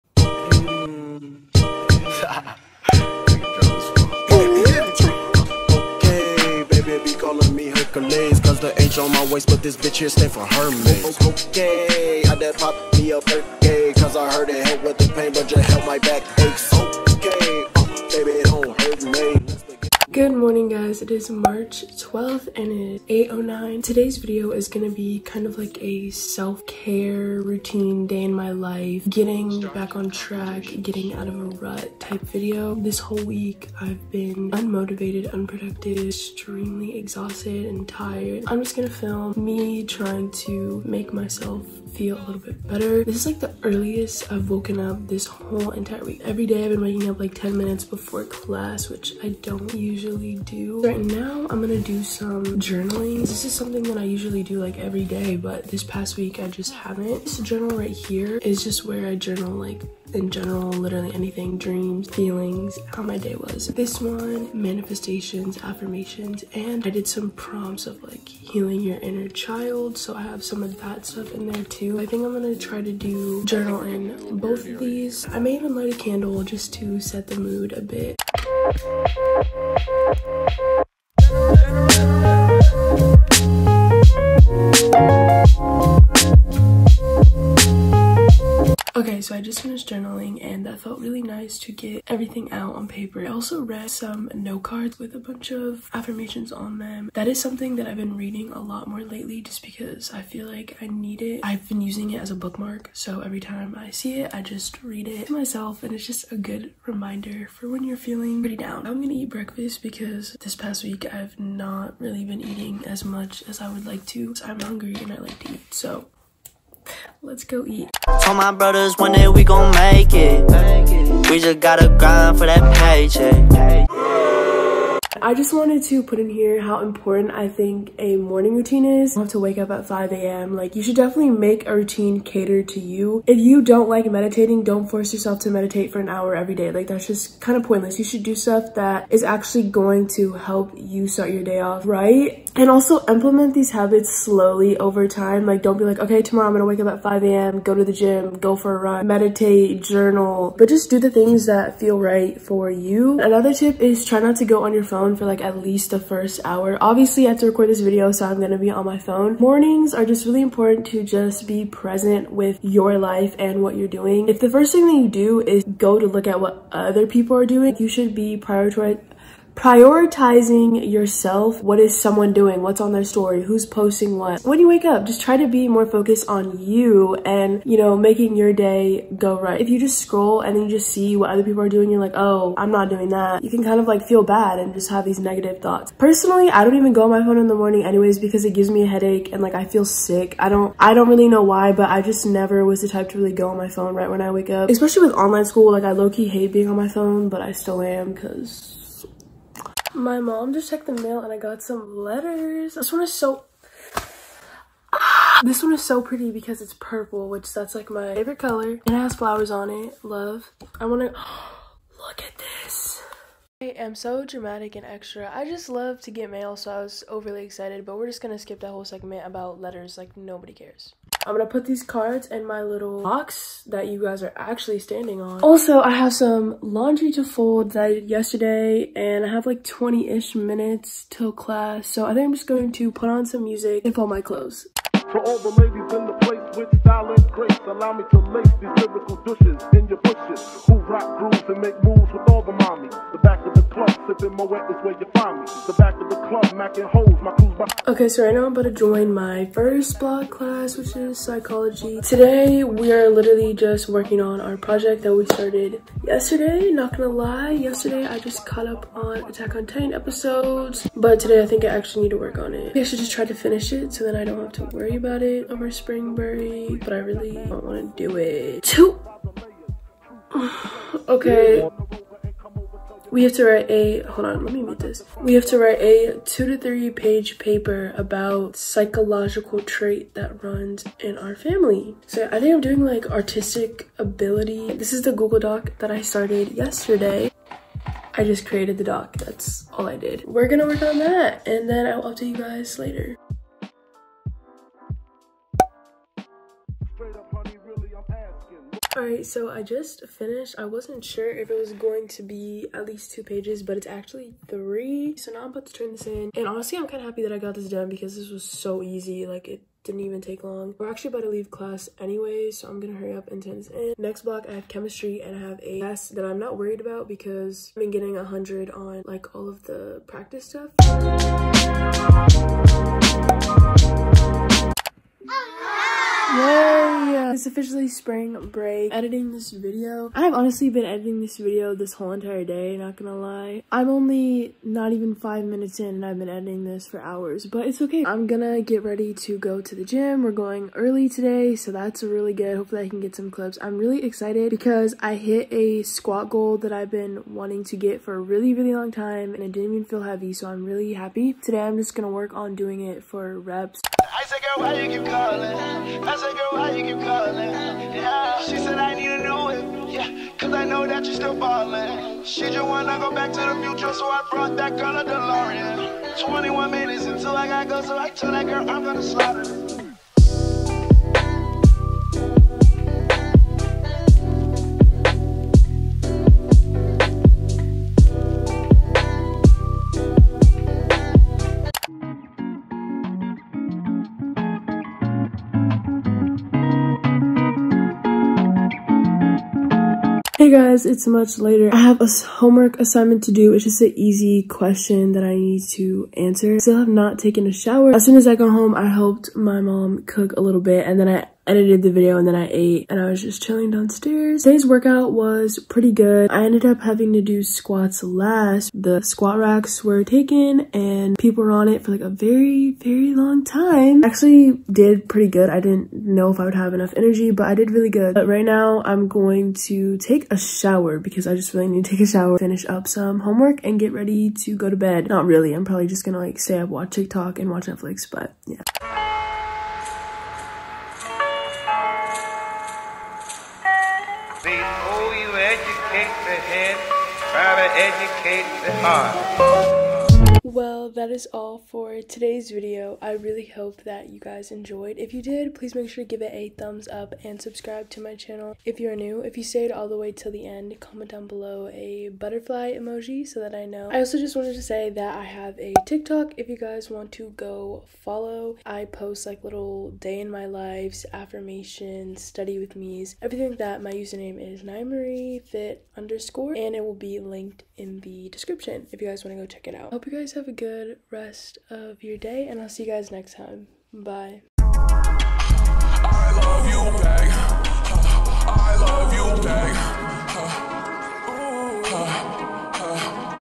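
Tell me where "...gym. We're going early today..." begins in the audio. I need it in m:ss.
5:39.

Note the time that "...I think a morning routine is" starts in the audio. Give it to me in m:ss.
2:07.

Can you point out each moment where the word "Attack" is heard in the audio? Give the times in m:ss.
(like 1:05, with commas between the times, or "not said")
4:19.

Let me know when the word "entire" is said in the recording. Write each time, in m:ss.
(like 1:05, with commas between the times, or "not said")
0:45, 5:32.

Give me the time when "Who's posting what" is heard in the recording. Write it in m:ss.
2:53.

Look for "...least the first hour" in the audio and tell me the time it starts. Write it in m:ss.
2:35.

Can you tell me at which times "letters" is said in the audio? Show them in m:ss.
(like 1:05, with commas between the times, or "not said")
3:21, 3:39.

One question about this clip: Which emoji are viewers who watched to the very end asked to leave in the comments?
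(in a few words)
Butterfly.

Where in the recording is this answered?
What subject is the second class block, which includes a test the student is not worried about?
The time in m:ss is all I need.
5:14.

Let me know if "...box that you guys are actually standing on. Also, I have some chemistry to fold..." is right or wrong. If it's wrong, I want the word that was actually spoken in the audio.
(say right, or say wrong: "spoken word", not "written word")
wrong: "laundry", not "chemistry".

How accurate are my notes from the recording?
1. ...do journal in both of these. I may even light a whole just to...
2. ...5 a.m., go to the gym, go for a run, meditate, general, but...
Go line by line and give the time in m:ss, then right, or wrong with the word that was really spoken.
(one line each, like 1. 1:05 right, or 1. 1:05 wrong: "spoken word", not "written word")
1. 1:12 wrong: "candle", not "whole"
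2. 2:27 wrong: "journal", not "general".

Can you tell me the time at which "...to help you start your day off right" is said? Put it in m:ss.
2:20.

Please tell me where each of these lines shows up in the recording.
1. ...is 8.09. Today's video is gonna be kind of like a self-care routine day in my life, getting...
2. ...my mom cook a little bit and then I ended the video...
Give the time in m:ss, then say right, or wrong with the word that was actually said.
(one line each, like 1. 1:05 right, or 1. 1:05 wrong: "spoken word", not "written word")
1. 0:23 right
2. 6:39 wrong: "edited", not "ended".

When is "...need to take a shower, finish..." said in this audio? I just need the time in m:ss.
7:01.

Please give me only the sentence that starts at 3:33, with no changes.
I am so dramatic and extra.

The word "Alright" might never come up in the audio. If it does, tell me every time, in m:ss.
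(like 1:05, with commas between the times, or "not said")
4:58.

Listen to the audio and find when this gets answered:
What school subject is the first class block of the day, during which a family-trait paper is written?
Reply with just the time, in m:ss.
4:11.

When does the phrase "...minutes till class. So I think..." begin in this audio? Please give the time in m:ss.
3:50.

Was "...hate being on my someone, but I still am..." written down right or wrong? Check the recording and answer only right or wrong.
wrong.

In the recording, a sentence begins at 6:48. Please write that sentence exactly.
The squat racks were taken and people were on it for like a very, very long time.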